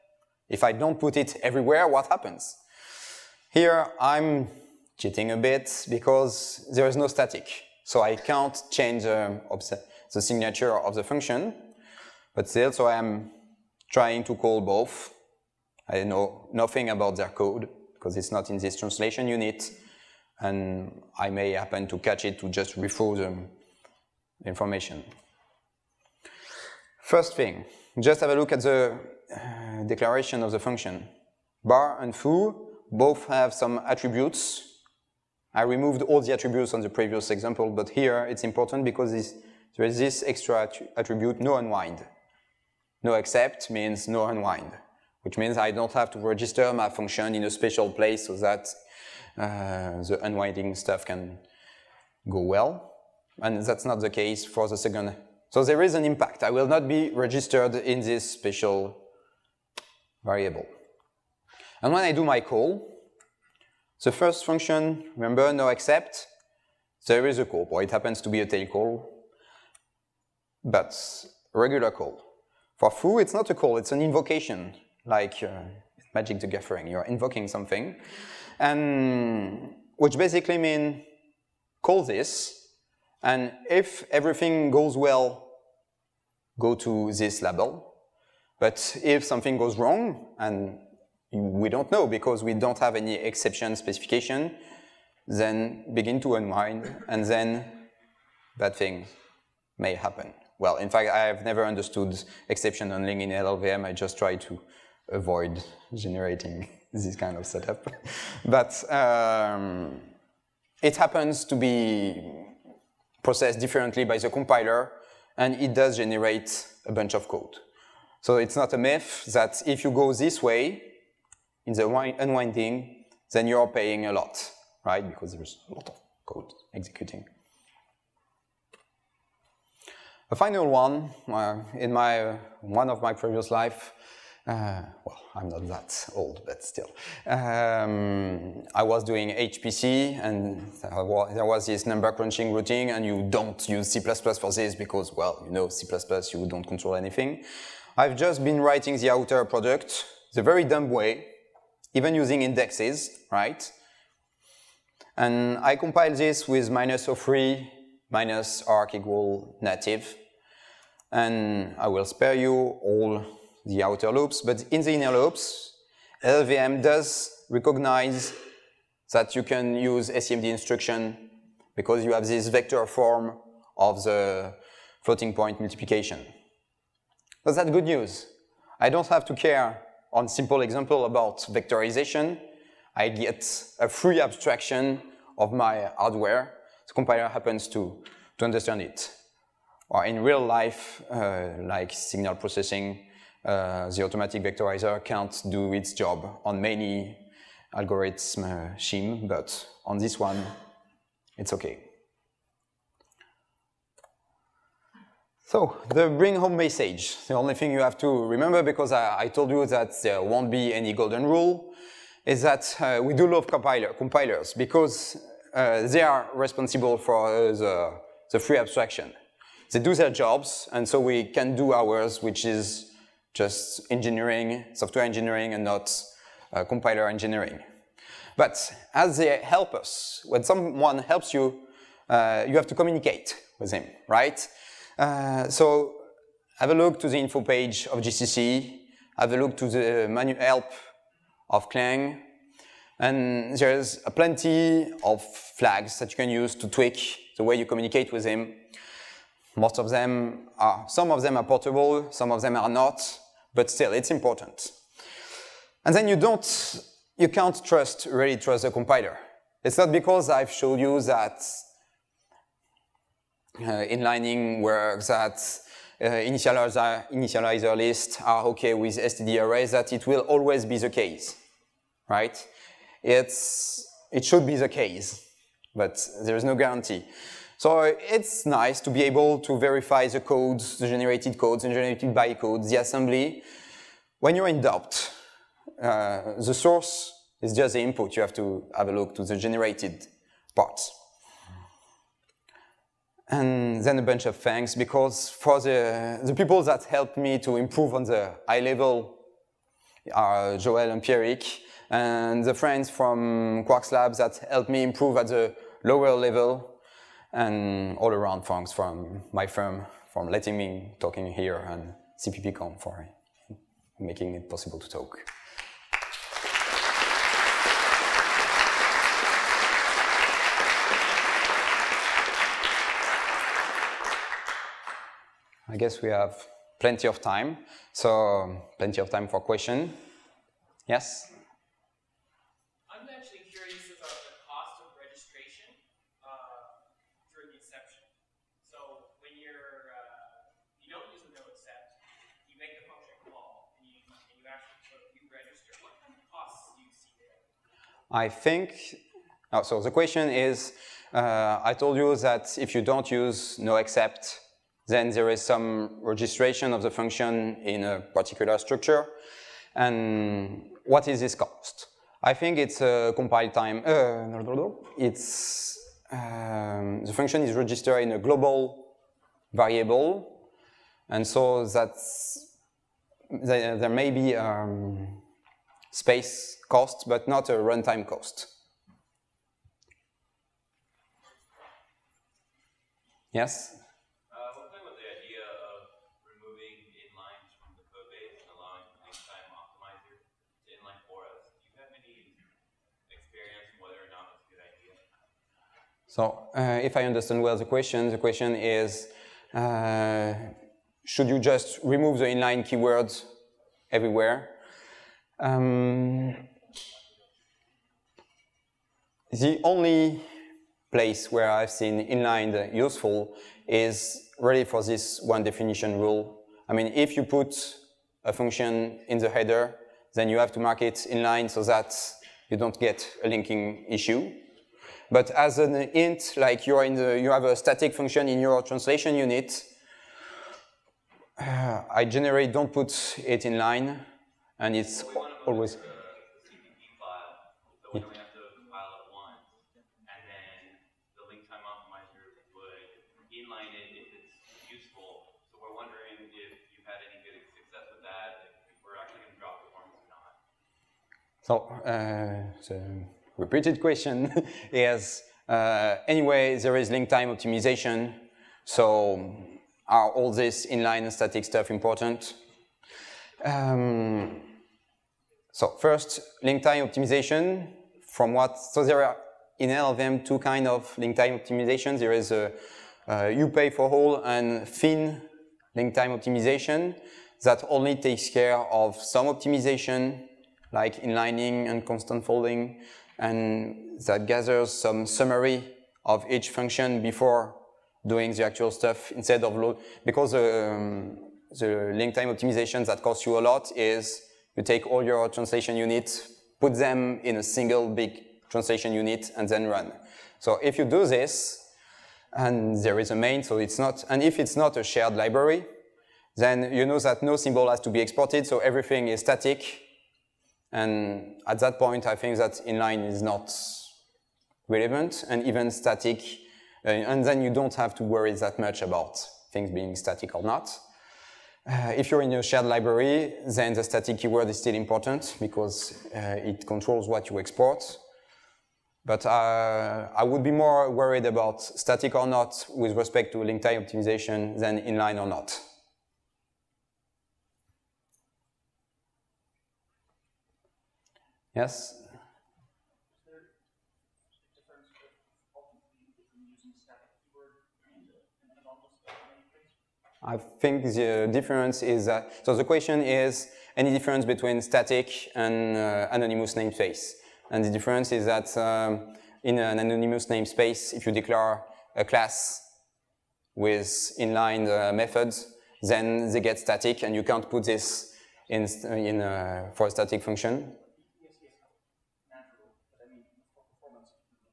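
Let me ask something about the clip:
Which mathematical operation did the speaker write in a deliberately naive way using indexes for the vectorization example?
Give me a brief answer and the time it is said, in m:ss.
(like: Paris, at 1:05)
outer product, at 2:29.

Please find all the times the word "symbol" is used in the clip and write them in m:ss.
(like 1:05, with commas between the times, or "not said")
8:27.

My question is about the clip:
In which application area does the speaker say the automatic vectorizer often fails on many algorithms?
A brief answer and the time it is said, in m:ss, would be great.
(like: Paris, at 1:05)
signal processing, at 3:11.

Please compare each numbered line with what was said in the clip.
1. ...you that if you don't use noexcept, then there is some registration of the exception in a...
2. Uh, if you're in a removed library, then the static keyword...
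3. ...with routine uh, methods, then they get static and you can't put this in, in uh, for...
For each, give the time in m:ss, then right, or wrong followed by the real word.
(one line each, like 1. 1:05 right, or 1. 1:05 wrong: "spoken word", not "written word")
1. 5:51 wrong: "function", not "exception"
2. 8:41 wrong: "shared", not "removed"
3. 9:23 wrong: "inline", not "routine".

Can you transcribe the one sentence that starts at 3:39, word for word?
They do their jobs, and so we can do ours, which is just engineering, software engineering, and not uh, compiler engineering.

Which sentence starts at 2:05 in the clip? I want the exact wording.
Because there's a lot of code executing.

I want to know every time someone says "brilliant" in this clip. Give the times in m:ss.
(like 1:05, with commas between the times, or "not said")
not said.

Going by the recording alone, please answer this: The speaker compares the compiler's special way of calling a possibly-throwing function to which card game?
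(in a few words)
Magic the Gathering.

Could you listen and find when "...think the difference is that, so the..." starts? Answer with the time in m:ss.
9:10.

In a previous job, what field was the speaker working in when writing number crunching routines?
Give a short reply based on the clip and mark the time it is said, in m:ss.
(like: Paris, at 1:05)
HPC, at 2:19.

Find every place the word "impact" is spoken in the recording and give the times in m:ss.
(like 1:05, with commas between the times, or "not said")
0:56.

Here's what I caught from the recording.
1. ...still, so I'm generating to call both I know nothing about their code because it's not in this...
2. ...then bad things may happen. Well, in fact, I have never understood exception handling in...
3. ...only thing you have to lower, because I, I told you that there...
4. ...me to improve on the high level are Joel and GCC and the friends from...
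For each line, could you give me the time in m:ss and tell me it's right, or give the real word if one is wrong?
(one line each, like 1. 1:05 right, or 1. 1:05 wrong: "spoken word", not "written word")
1. 0:12 wrong: "trying", not "generating"
2. 1:37 right
3. 3:27 wrong: "remember", not "lower"
4. 4:57 wrong: "Pierrick", not "GCC".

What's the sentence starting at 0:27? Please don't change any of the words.
First thing, just have a look at the uh, declaration of the function.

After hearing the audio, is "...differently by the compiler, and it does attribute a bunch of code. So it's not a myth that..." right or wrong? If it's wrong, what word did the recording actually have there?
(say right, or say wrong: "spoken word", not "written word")
wrong: "generate", not "attribute".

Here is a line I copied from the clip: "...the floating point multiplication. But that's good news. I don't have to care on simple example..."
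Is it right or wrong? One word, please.
right.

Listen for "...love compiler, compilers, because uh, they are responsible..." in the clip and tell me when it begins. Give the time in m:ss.
3:33.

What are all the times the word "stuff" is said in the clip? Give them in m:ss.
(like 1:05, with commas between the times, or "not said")
0:50, 7:41, 8:08.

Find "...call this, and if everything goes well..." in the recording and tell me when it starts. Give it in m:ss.
1:21.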